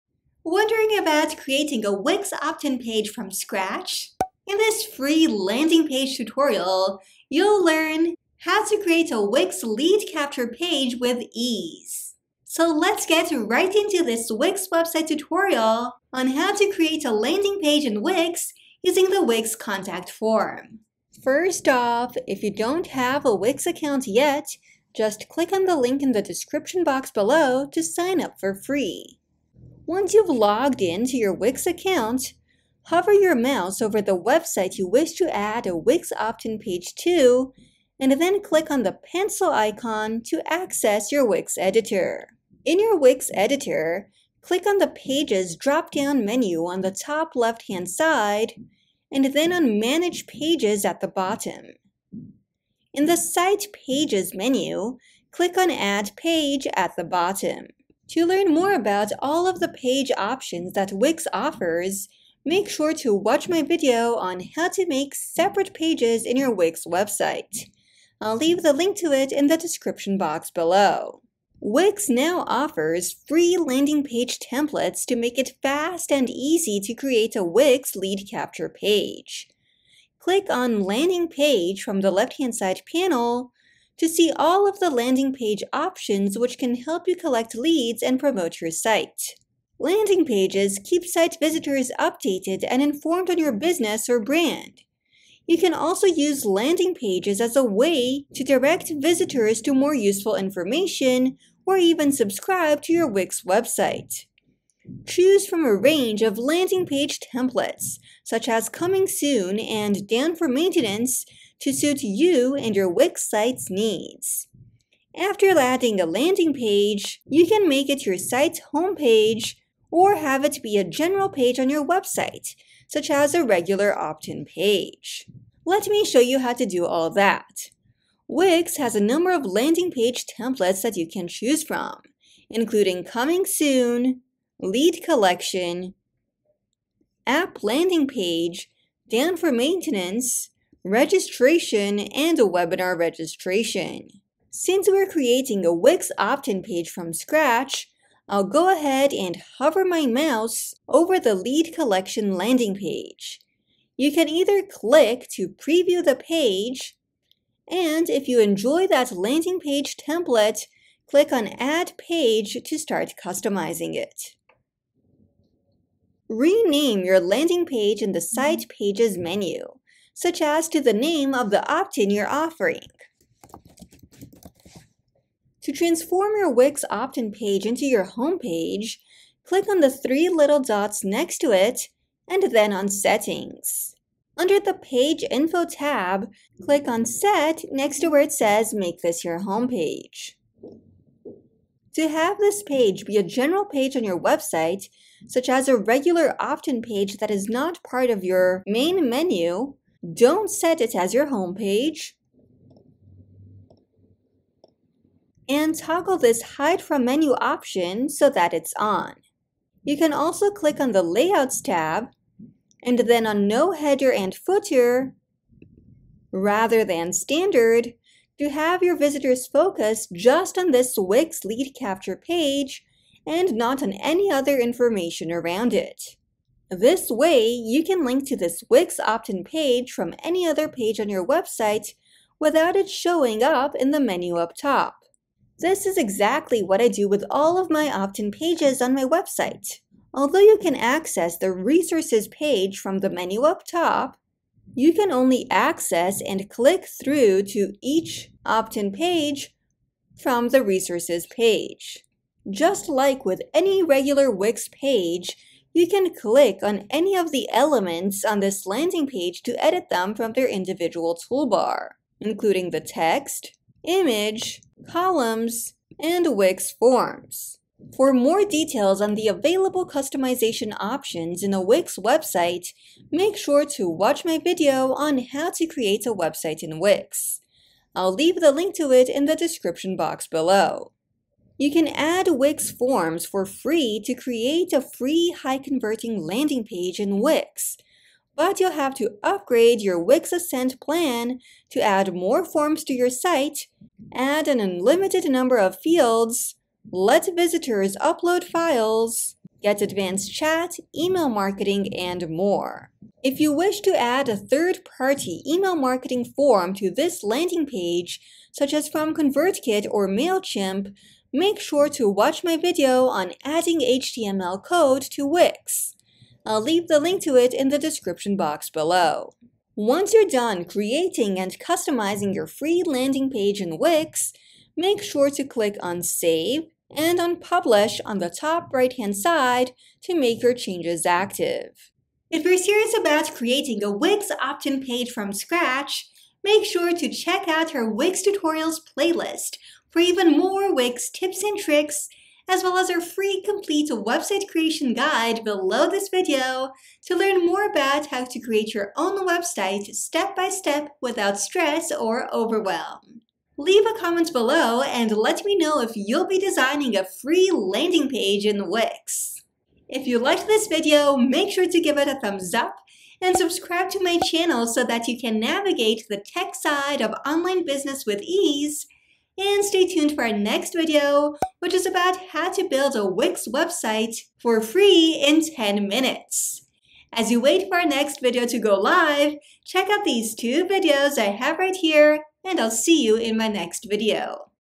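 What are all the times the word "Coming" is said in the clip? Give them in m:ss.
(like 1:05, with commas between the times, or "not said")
1:48, 2:13.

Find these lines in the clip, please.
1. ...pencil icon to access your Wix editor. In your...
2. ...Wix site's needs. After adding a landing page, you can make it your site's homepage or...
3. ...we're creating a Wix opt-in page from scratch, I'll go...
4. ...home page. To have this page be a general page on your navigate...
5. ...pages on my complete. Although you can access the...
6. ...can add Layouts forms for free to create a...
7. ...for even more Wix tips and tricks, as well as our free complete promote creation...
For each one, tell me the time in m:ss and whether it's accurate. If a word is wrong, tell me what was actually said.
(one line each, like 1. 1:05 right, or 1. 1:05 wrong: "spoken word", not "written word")
1. 0:38 right
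2. 1:52 right
3. 2:24 right
4. 3:09 wrong: "website", not "navigate"
5. 3:58 wrong: "website", not "complete"
6. 4:41 wrong: "Wix", not "Layouts"
7. 5:39 wrong: "website", not "promote".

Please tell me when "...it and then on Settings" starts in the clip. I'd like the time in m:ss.
3:01.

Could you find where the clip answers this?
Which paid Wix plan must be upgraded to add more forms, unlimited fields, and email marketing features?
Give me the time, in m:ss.
4:50.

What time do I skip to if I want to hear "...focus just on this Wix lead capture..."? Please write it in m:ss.
3:39.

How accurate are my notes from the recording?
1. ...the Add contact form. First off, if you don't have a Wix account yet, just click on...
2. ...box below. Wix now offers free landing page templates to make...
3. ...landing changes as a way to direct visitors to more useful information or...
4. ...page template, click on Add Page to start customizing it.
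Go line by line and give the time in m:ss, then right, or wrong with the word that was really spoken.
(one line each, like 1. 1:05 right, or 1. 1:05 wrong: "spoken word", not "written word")
1. 0:19 wrong: "Wix", not "Add"
2. 1:10 right
3. 1:36 wrong: "pages", not "changes"
4. 2:39 right.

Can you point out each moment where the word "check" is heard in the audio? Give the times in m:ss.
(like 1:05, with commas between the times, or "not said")
5:37, 6:19.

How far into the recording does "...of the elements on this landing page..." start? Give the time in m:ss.
4:17.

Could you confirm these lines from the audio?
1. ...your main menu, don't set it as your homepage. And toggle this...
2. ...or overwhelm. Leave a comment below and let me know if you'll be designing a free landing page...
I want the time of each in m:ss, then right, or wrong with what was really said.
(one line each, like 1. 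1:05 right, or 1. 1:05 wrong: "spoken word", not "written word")
1. 3:18 right
2. 5:51 right.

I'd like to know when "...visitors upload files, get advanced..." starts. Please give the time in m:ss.
4:57.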